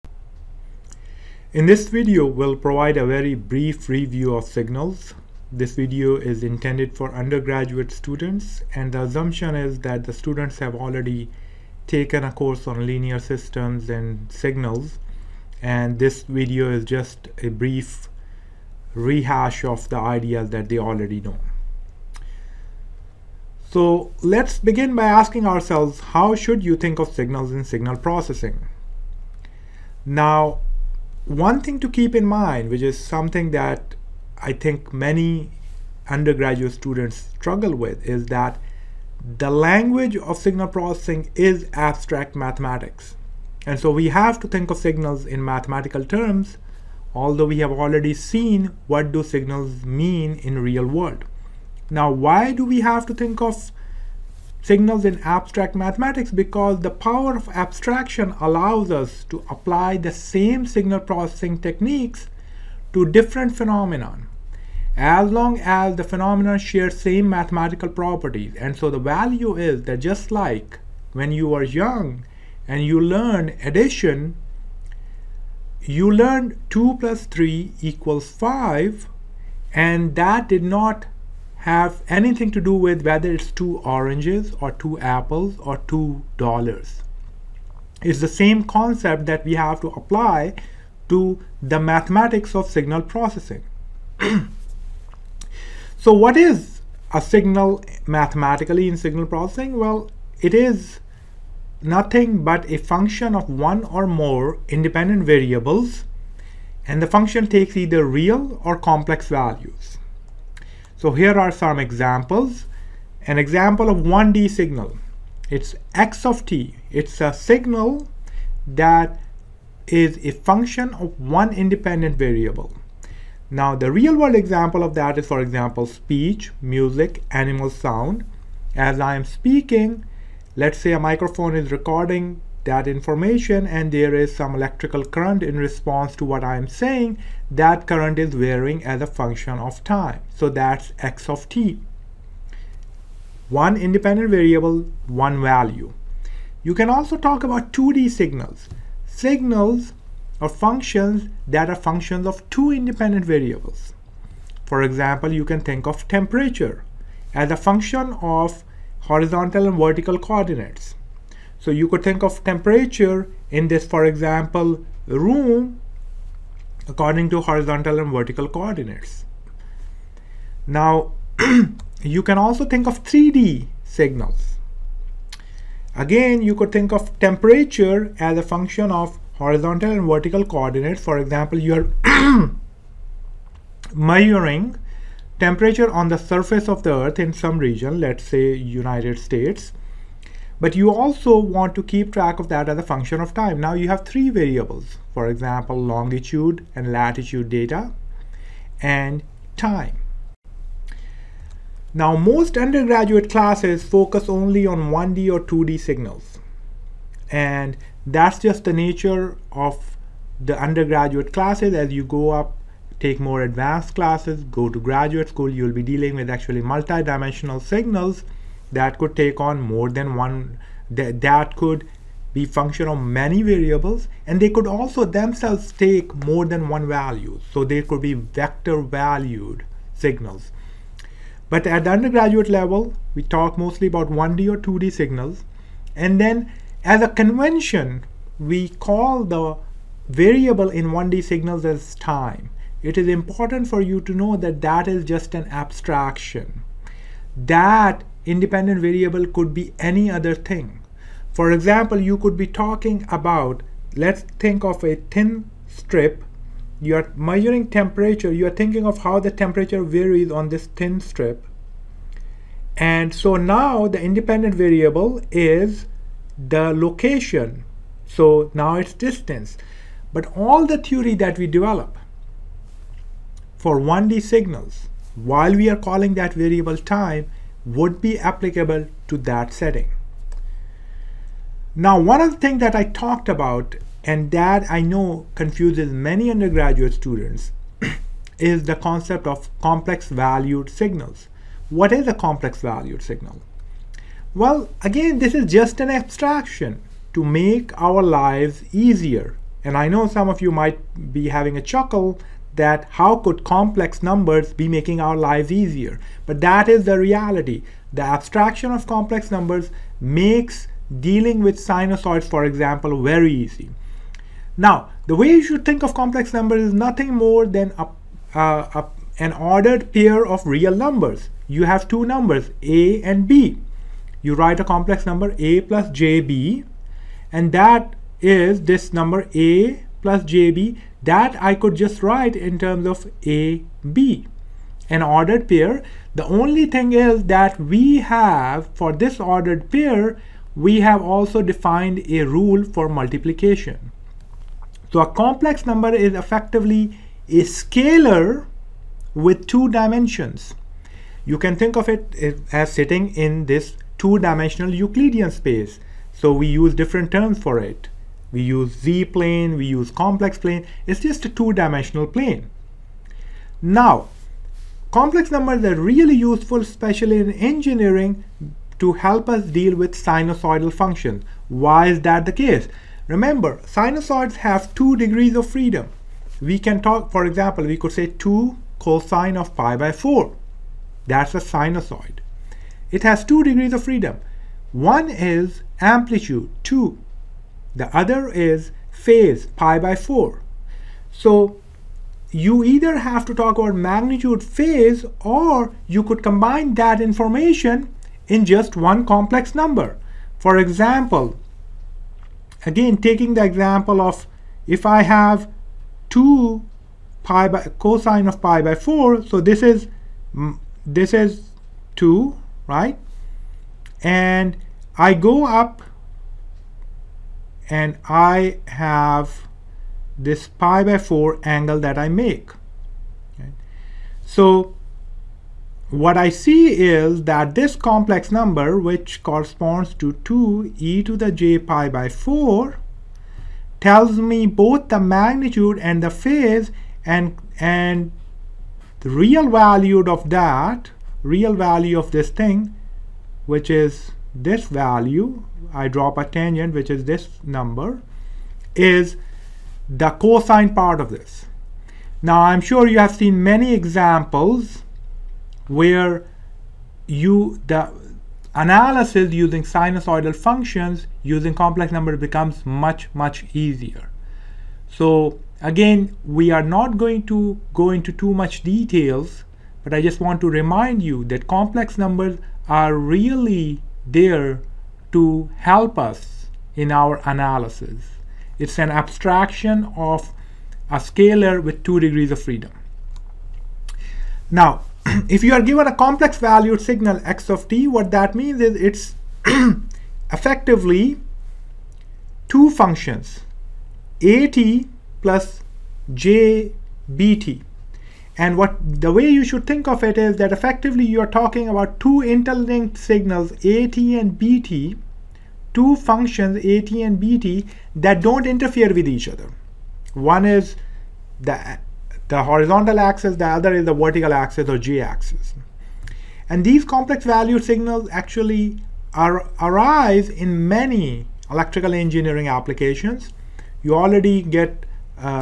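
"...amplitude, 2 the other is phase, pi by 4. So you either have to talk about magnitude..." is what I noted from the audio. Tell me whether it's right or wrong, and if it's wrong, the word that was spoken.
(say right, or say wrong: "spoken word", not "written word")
right.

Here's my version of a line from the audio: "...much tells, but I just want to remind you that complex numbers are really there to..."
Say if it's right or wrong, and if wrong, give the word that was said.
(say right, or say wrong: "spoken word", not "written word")
wrong: "details", not "tells".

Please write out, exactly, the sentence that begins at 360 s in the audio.
It's just a two dimensional plane.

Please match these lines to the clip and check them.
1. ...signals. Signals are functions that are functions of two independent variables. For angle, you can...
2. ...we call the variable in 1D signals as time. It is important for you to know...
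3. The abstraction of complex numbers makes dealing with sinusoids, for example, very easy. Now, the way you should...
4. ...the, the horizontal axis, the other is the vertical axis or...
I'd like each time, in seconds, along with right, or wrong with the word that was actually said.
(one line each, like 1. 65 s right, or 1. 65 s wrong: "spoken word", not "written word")
1. 148 s wrong: "example", not "angle"
2. 238 s right
3. 307 s right
4. 511 s right.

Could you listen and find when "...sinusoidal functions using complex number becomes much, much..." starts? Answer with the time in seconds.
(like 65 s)
459 s.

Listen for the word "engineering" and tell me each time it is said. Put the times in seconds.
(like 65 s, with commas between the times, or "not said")
367 s, 521 s.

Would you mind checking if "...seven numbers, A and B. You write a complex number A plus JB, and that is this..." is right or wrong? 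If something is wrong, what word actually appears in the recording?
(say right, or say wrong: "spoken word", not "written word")
wrong: "two", not "seven".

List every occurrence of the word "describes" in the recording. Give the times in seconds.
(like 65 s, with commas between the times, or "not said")
not said.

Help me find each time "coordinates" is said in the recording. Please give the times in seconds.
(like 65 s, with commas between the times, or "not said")
160 s, 168 s, 180 s.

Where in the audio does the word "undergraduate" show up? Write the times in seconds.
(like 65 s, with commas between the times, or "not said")
7 s, 36 s, 202 s, 210 s, 231 s, 286 s.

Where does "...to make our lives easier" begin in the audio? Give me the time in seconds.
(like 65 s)
297 s.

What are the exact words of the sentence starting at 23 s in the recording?
So let's begin by asking ourselves how should you think of signals in signal processing?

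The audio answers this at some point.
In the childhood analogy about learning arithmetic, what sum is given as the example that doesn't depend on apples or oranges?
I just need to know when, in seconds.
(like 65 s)
76 s.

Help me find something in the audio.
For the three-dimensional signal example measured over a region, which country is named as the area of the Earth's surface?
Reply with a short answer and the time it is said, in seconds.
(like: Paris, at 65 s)
United States, at 188 s.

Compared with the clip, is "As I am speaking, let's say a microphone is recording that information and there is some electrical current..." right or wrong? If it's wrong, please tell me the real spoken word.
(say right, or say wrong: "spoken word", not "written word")
right.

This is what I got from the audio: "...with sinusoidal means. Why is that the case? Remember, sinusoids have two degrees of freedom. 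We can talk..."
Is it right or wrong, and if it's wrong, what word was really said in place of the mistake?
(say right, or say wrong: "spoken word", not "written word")
wrong: "functions", not "means".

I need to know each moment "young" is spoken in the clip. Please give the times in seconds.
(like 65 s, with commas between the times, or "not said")
71 s.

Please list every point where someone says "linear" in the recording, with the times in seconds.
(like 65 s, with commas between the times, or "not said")
12 s.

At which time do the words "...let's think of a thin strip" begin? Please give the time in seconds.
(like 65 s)
253 s.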